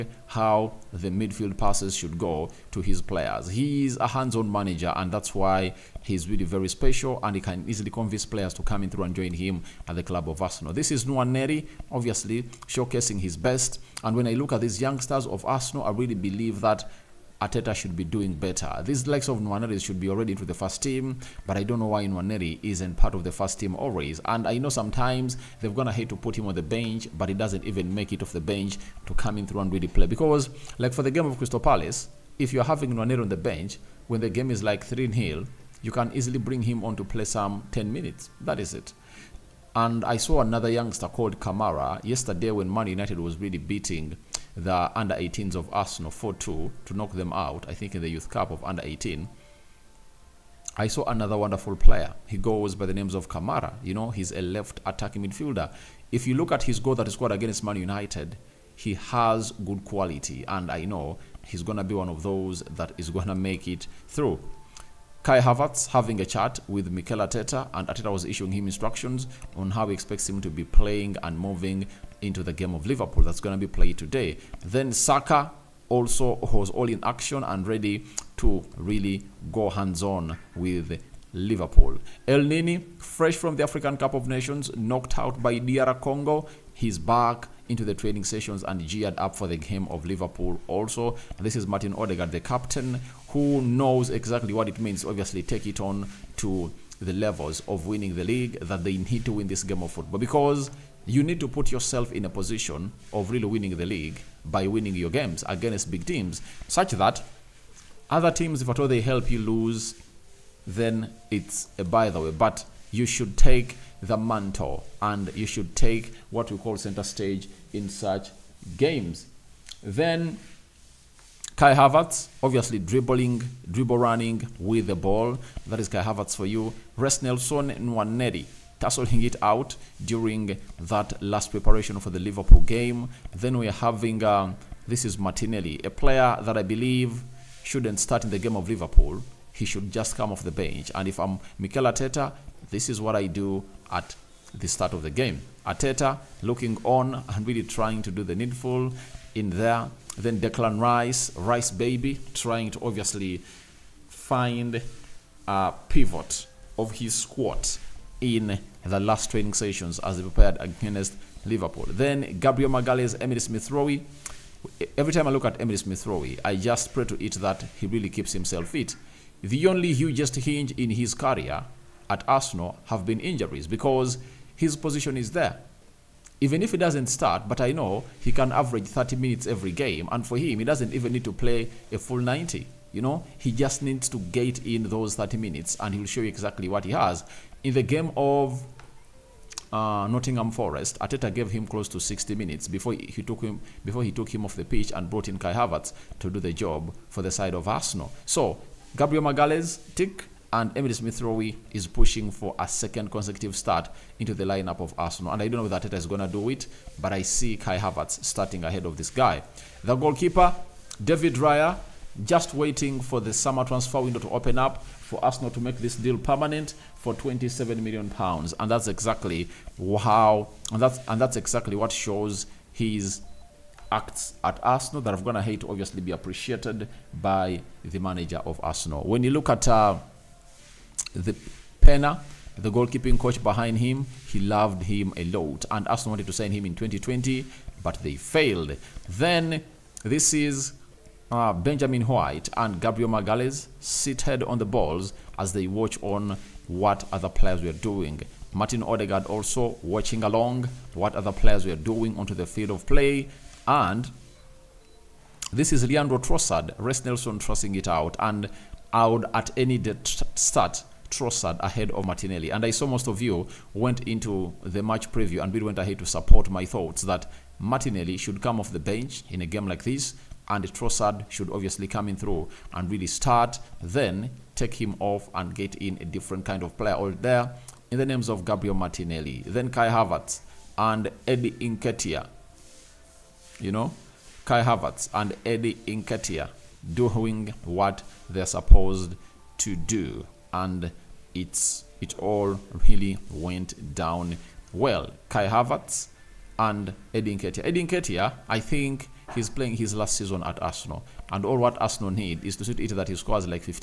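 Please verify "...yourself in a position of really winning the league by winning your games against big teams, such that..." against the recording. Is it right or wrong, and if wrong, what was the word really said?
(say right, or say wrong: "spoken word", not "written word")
right.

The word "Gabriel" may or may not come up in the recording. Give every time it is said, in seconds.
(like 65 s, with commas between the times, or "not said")
162 s, 198 s, 242 s, 278 s.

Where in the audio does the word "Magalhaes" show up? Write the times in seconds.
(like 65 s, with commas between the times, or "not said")
162 s, 199 s, 243 s.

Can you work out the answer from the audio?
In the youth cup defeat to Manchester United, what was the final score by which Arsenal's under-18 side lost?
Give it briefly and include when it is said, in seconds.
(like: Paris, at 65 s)
4-2, at 46 s.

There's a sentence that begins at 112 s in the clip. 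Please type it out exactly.
But you should take the mantle and you should take what we call center stage in such games.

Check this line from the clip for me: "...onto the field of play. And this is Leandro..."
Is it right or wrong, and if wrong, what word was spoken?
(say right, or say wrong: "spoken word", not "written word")
right.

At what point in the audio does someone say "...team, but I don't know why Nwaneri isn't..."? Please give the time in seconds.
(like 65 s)
20 s.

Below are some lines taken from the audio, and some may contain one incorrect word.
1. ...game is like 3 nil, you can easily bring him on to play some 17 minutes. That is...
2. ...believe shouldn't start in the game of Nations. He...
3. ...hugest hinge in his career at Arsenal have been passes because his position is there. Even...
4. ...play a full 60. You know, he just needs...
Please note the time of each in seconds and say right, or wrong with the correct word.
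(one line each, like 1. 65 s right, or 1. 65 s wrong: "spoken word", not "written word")
1. 34 s wrong: "10", not "17"
2. 136 s wrong: "Liverpool", not "Nations"
3. 169 s wrong: "injuries", not "passes"
4. 181 s wrong: "90", not "60".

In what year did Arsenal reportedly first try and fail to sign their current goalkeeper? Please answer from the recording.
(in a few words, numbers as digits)
2020.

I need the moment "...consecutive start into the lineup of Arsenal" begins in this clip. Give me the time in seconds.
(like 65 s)
203 s.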